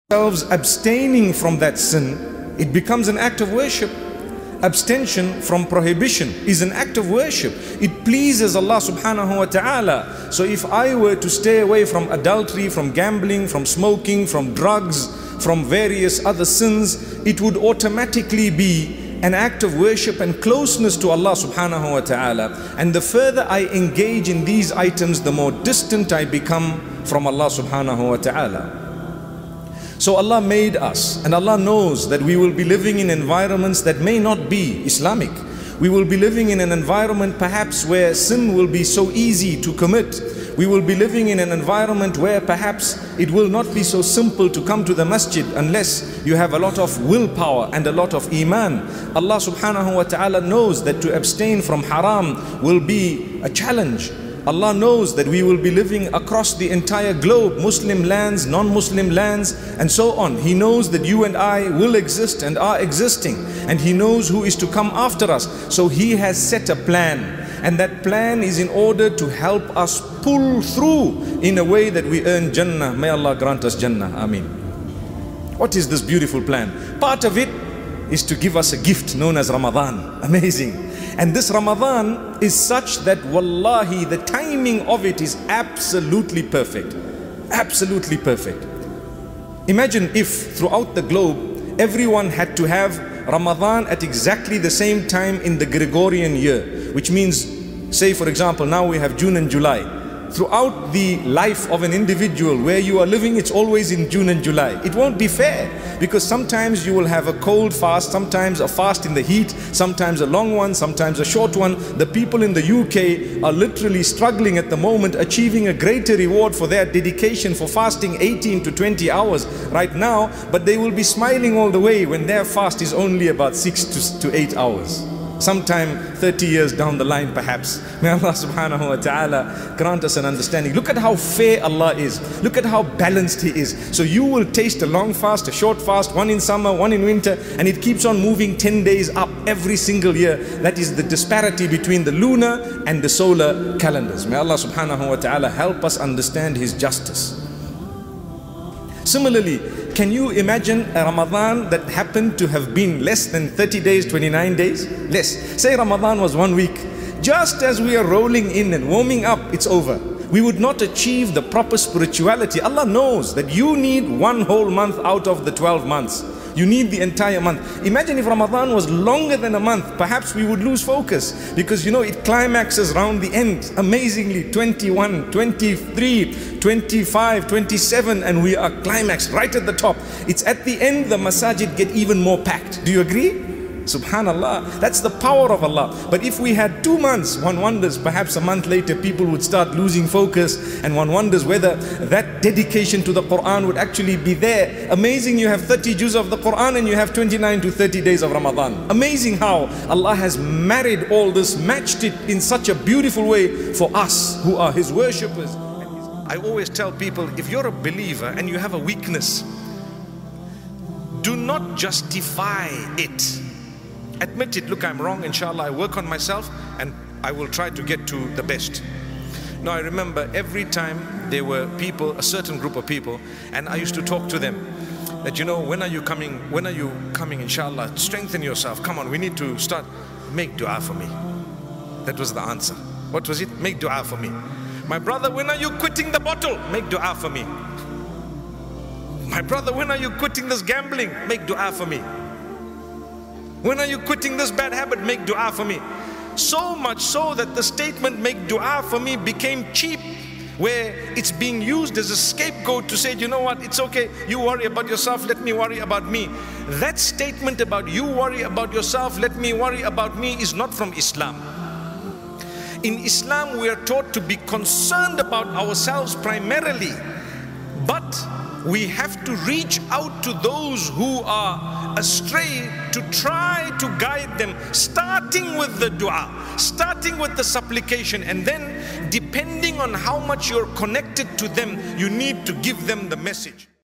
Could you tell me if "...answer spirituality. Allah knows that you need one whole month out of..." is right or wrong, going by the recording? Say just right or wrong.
wrong.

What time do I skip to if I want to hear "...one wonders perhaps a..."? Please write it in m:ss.
3:07.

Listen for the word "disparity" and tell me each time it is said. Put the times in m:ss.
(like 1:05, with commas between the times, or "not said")
2:21.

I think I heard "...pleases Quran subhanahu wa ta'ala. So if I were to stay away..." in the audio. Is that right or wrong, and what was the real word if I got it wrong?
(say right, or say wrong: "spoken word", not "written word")
wrong: "Allah", not "Quran".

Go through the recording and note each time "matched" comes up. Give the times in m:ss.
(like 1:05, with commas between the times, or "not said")
3:21.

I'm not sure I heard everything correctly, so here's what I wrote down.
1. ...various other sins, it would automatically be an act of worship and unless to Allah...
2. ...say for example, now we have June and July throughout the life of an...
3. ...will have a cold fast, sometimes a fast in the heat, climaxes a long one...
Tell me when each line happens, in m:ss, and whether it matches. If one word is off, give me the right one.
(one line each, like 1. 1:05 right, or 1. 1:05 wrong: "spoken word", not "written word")
1. 0:15 wrong: "closeness", not "unless"
2. 1:37 right
3. 1:46 wrong: "sometimes", not "climaxes".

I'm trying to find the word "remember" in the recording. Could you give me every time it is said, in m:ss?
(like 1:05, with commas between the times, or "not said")
3:39.